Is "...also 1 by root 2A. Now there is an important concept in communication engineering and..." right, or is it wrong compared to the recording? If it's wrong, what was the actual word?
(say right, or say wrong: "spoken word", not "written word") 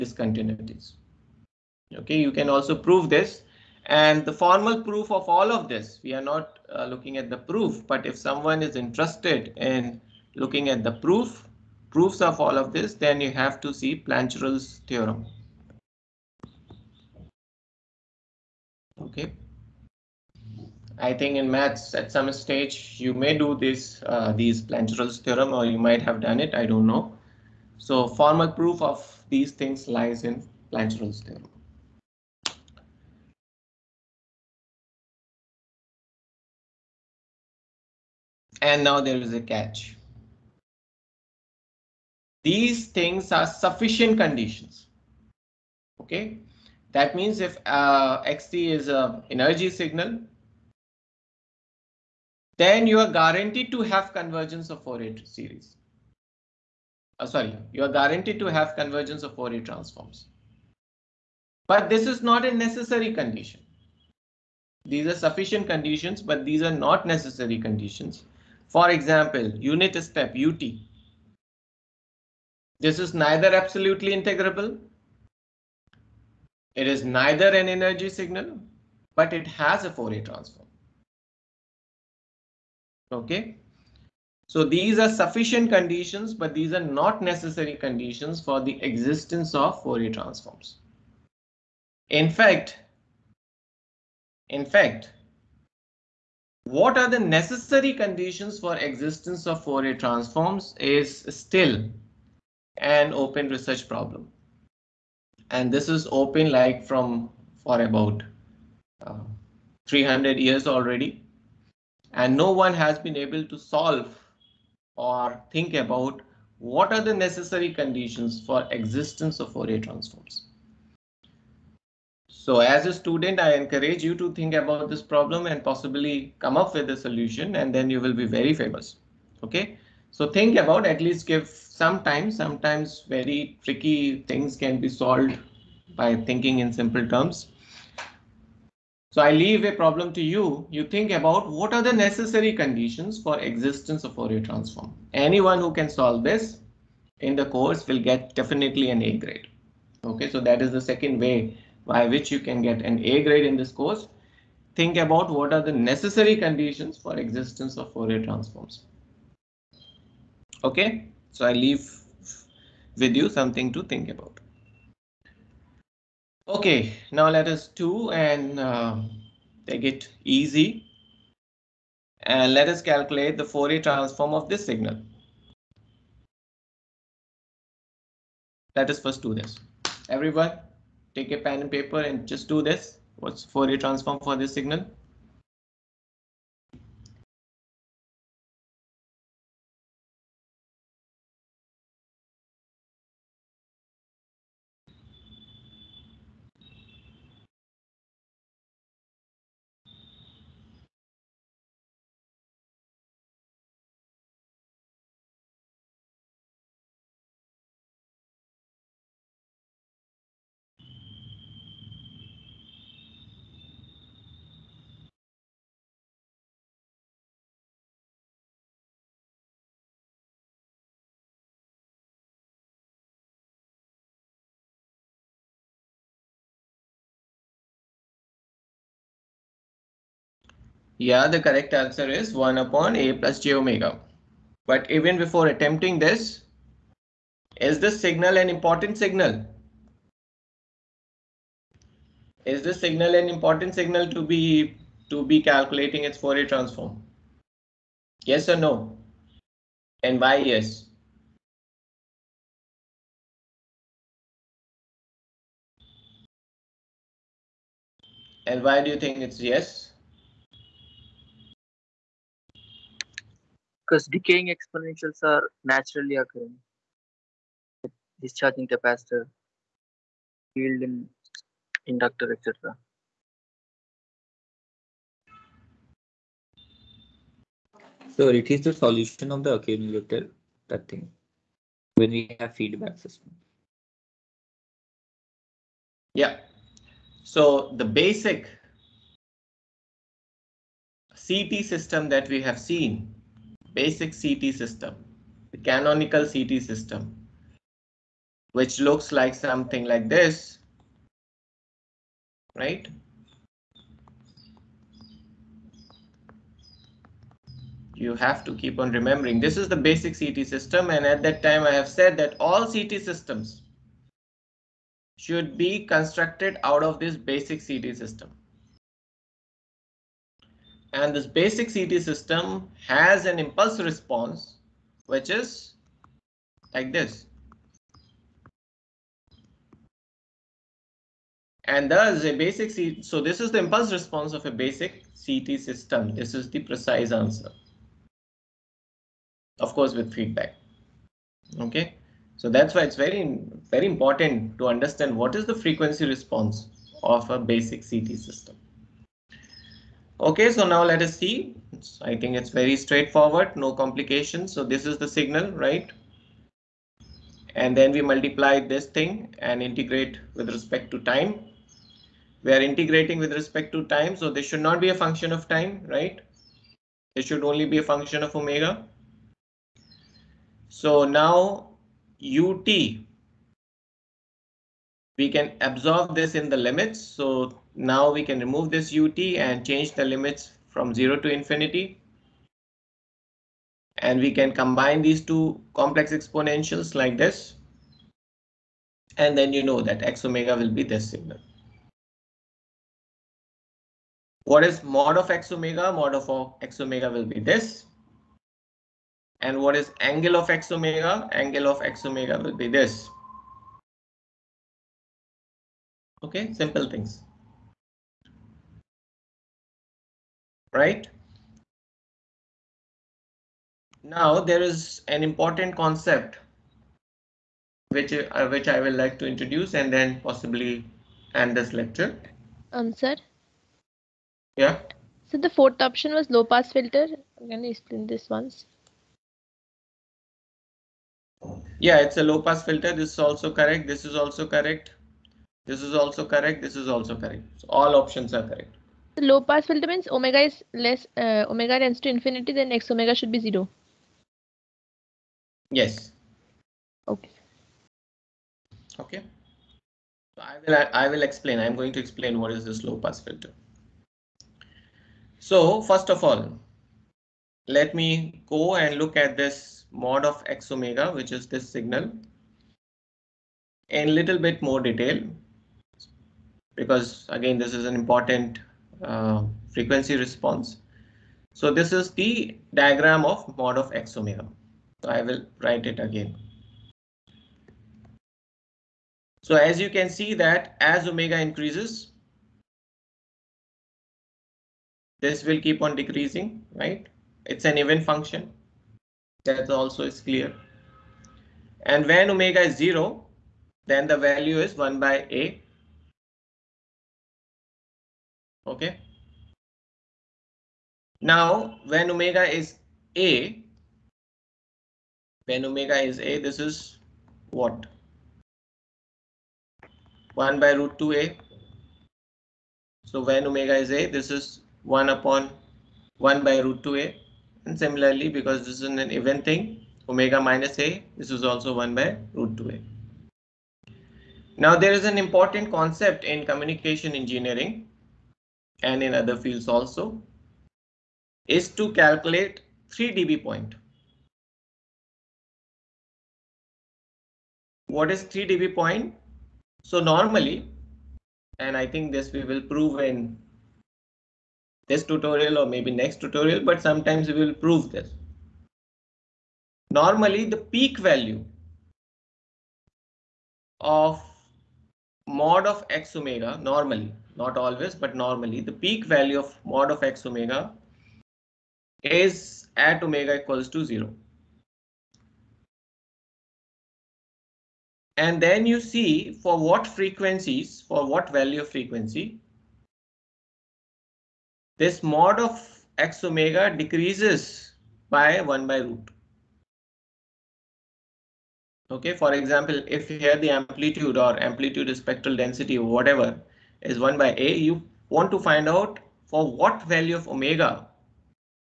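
right.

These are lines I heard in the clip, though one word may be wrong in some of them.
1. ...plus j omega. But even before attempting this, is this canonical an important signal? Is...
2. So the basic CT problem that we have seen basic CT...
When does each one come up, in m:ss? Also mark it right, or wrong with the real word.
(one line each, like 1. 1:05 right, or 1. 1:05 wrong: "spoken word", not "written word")
1. 3:53 wrong: "signal", not "canonical"
2. 4:47 wrong: "system", not "problem".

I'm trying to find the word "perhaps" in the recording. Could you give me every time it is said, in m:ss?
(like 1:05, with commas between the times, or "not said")
not said.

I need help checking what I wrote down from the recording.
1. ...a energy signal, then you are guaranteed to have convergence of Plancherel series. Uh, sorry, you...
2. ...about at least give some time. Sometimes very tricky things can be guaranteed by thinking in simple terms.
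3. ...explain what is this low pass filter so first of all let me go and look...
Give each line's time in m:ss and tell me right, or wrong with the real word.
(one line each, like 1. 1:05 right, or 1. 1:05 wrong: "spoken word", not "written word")
1. 0:48 wrong: "Fourier", not "Plancherel"
2. 2:10 wrong: "solved", not "guaranteed"
3. 7:31 right.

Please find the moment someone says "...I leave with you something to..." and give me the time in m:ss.
2:41.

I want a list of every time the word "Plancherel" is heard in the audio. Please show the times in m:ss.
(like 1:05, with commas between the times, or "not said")
0:13, 0:24, 0:30.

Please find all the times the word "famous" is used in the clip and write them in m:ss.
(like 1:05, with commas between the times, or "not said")
2:08.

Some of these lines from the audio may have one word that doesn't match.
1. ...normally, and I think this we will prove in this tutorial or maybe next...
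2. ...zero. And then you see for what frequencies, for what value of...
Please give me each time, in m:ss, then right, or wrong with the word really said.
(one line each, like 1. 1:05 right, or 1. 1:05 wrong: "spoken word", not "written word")
1. 8:59 right
2. 9:23 right.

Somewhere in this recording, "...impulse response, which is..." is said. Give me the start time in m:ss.
5:23.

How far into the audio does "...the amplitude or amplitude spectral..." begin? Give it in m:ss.
9:43.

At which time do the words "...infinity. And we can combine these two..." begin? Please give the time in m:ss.
6:21.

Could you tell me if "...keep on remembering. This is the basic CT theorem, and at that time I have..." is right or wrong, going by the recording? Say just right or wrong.
wrong.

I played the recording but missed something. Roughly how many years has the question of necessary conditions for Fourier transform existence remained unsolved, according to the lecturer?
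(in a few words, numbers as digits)
300 years.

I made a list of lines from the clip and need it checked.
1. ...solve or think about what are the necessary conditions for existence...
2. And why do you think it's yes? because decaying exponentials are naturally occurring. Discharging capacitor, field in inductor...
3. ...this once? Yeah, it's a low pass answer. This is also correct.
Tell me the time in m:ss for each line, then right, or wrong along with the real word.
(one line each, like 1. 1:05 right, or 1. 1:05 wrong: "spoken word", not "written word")
1. 1:53 right
2. 4:18 right
3. 7:08 wrong: "filter", not "answer".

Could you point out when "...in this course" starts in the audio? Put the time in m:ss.
2:33.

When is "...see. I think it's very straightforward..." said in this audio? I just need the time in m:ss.
5:51.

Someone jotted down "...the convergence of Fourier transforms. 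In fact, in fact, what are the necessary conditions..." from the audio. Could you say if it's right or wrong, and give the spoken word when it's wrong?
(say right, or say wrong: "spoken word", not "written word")
wrong: "existence", not "convergence".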